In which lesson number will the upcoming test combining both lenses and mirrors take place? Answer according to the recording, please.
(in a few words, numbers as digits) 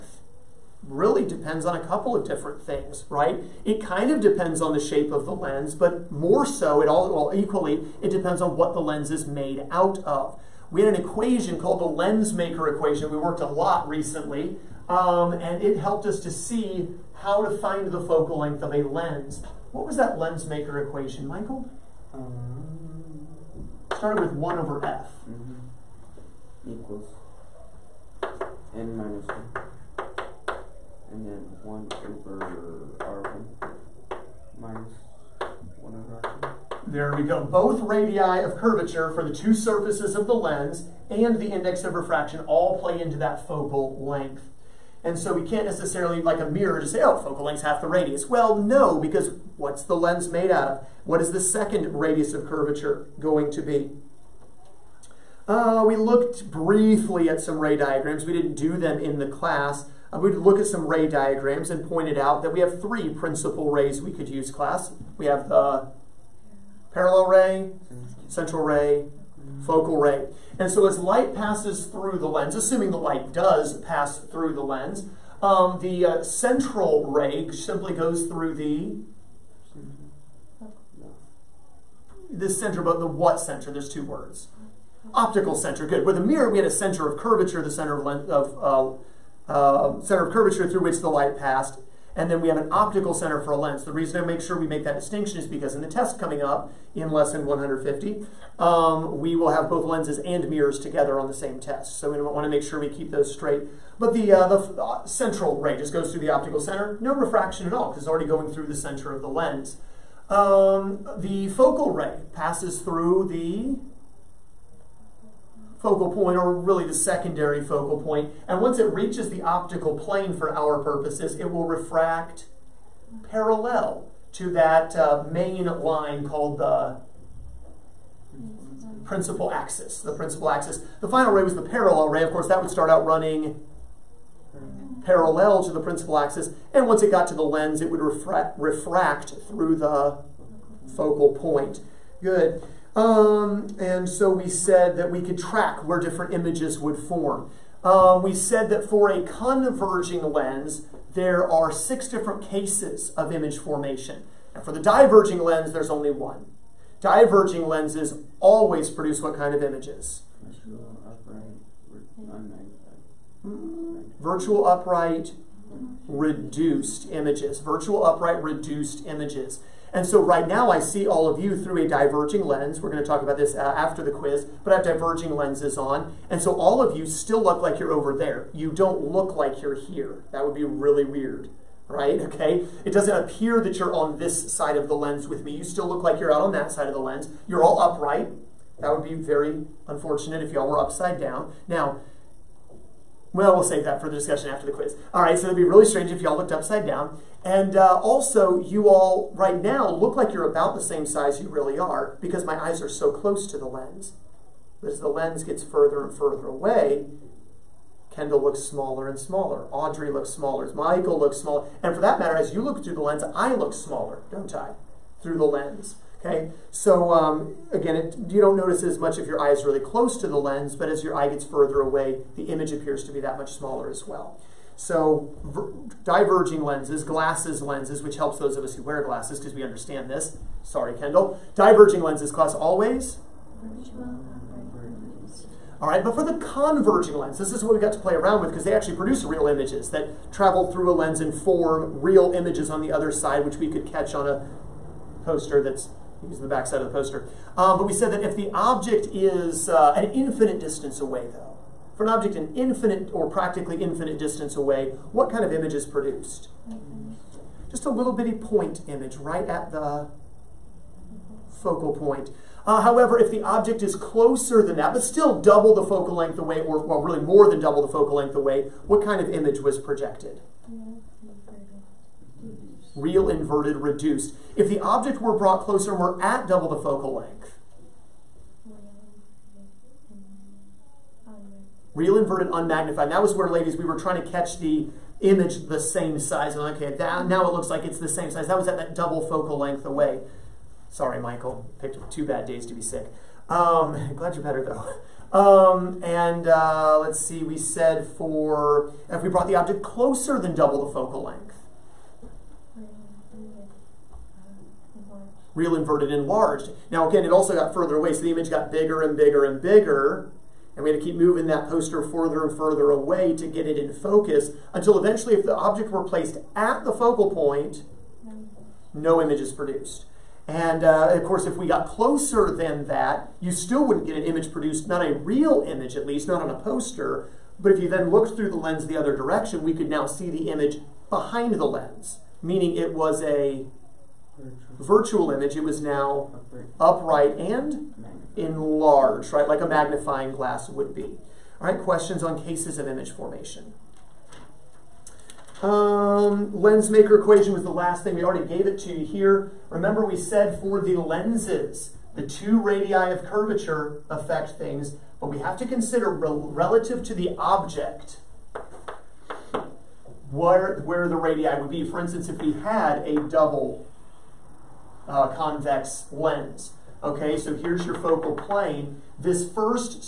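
150.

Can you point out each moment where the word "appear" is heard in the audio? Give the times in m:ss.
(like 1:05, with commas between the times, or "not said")
3:03, 3:42.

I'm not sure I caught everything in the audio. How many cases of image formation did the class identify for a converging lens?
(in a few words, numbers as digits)
6.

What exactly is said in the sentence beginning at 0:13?
We worked a lot recently, um, and it helped us to see how to find the focal length of a lens.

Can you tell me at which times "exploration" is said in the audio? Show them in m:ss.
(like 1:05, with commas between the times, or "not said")
not said.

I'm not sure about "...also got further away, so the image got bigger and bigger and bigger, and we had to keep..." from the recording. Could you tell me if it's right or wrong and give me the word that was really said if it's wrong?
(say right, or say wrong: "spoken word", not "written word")
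right.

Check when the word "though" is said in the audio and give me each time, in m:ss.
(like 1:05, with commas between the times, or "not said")
4:11, 4:54.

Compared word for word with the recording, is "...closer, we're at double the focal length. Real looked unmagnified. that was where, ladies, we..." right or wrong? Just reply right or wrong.
wrong.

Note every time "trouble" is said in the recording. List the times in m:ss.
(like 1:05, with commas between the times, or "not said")
not said.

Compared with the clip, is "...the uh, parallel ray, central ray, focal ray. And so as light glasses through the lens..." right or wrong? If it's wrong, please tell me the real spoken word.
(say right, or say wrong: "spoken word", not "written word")
wrong: "passes", not "glasses".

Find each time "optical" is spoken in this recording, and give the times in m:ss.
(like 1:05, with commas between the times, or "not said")
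1:25, 1:32, 1:46, 1:59.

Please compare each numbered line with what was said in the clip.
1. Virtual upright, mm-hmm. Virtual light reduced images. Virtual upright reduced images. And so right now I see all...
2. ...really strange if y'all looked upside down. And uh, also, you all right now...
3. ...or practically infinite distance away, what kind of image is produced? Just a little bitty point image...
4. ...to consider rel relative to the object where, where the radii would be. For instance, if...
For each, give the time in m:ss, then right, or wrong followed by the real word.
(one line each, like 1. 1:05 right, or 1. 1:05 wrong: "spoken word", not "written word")
1. 2:40 wrong: "upright", not "light"
2. 3:15 right
3. 4:13 right
4. 5:55 right.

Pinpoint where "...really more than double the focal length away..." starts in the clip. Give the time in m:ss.
4:27.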